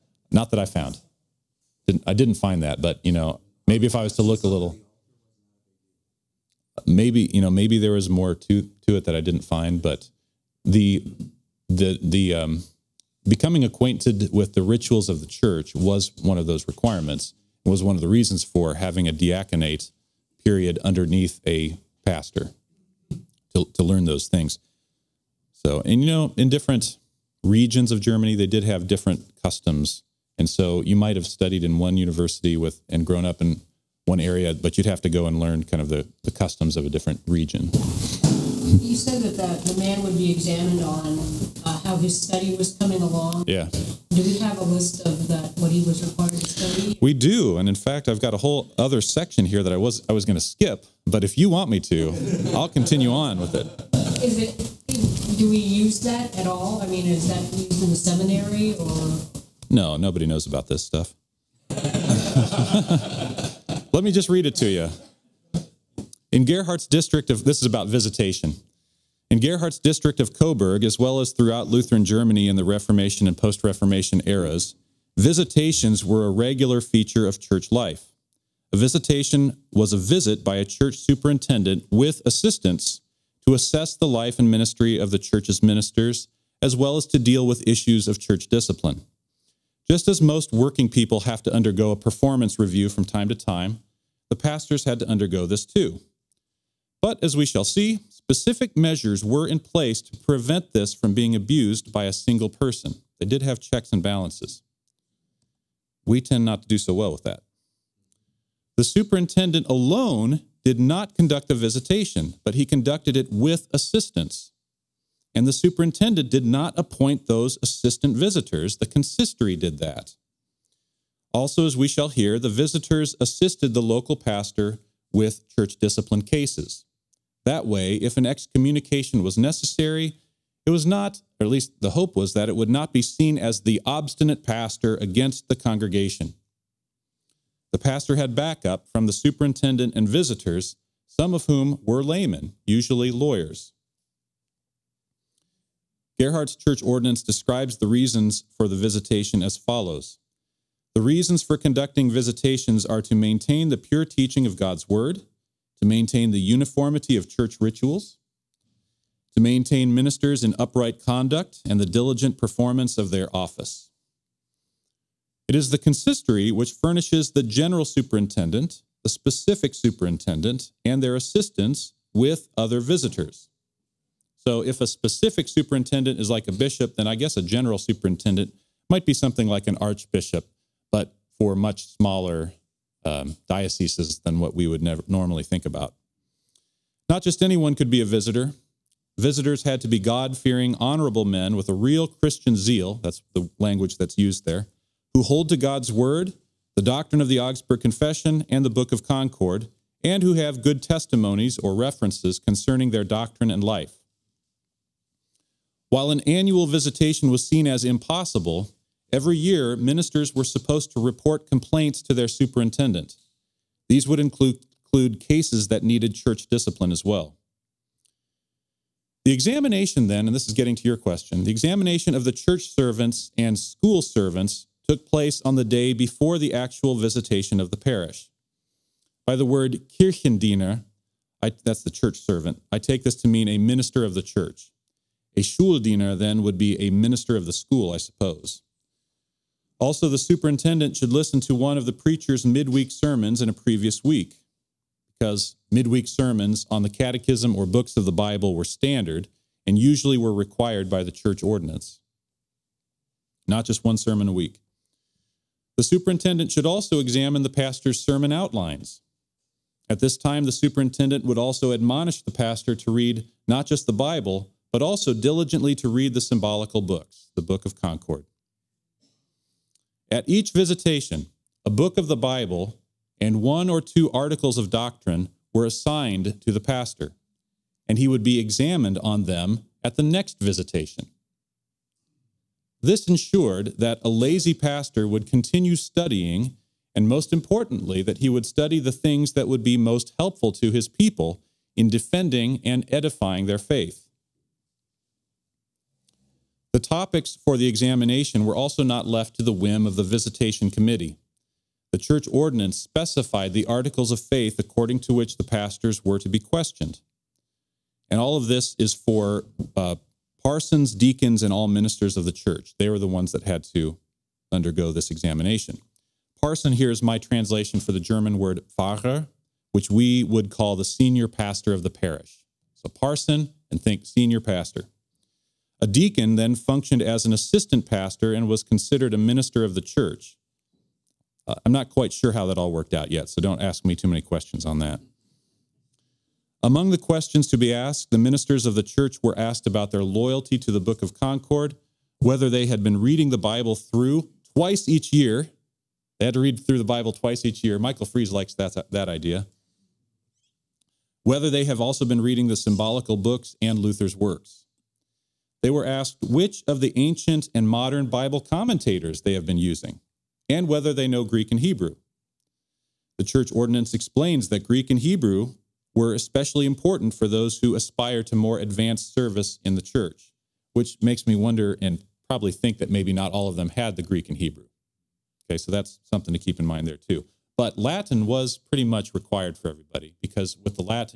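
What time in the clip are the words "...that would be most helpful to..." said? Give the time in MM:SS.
04:49.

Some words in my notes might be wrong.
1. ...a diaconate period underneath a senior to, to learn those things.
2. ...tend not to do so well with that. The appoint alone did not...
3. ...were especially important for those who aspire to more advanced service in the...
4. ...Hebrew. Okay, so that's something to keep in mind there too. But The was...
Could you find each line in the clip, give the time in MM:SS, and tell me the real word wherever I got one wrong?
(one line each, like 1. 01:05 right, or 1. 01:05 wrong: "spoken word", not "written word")
1. 00:19 wrong: "pastor", not "senior"
2. 01:46 wrong: "superintendent", not "appoint"
3. 06:05 right
4. 06:14 wrong: "Latin", not "The".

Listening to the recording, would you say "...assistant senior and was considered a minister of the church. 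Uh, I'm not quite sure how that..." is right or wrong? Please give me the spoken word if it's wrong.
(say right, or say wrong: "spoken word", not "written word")
wrong: "pastor", not "senior".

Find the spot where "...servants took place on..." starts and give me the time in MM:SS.
03:44.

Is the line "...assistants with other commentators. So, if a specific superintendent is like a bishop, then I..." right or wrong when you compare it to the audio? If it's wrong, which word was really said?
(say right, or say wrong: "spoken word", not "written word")
wrong: "visitors", not "commentators".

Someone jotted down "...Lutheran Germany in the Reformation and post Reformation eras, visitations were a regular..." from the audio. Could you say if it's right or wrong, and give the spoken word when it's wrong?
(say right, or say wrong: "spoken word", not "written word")
right.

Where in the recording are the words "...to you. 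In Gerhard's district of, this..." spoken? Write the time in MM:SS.
01:04.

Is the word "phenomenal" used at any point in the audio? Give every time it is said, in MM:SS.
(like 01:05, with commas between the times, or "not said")
not said.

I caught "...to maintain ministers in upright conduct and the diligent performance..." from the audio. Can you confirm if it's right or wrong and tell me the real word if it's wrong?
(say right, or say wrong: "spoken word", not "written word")
right.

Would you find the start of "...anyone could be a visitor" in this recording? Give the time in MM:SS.
03:07.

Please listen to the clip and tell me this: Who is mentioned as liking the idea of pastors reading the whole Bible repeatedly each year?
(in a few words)
Michael Fries.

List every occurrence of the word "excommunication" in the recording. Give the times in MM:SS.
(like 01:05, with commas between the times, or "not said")
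02:08.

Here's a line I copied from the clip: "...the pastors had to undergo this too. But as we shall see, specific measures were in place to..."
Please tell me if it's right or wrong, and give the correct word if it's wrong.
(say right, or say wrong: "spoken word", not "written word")
right.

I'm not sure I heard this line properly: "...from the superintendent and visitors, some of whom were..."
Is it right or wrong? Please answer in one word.
right.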